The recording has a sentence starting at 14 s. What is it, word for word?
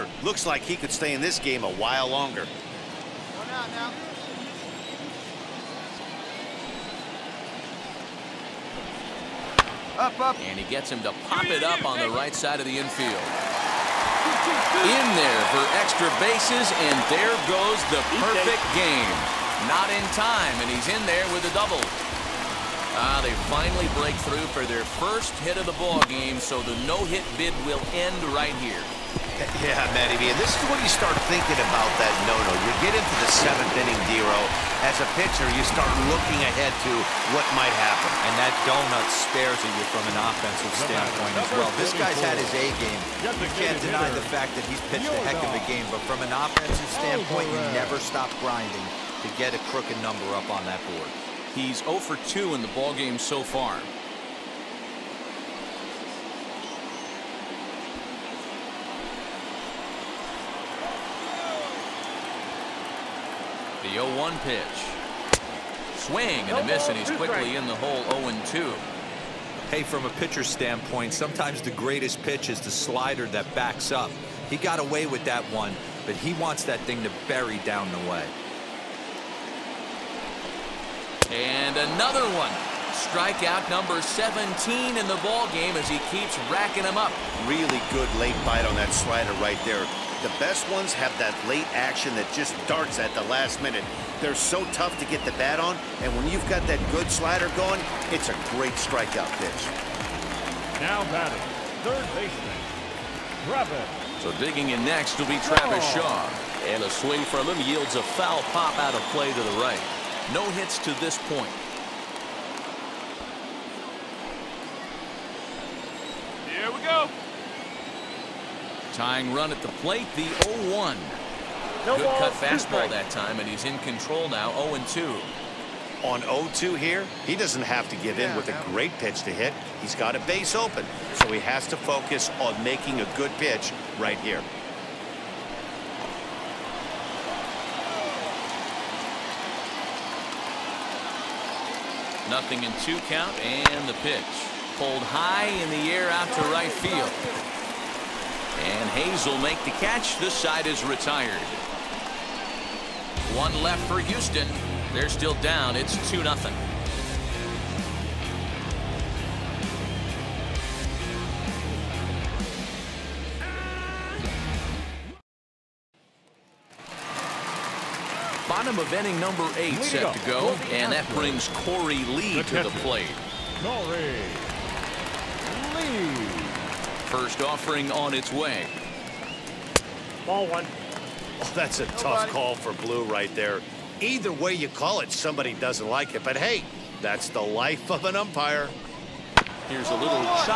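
In there for extra bases, and there goes the perfect game.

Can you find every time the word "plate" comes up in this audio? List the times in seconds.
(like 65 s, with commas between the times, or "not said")
119 s, 172 s.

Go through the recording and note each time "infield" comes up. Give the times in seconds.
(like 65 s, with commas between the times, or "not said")
12 s.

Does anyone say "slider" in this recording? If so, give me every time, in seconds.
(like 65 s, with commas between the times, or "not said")
72 s, 88 s, 97 s.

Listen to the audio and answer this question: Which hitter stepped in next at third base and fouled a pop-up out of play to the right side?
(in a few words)
Travis Shaw.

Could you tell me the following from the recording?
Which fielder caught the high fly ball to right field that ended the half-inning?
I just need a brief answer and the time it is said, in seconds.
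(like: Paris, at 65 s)
Hayes, at 148 s.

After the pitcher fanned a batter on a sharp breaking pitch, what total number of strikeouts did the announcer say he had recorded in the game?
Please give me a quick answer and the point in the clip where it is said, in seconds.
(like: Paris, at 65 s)
17, at 84 s.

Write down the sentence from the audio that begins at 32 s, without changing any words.
You get into the seventh inning, Dero.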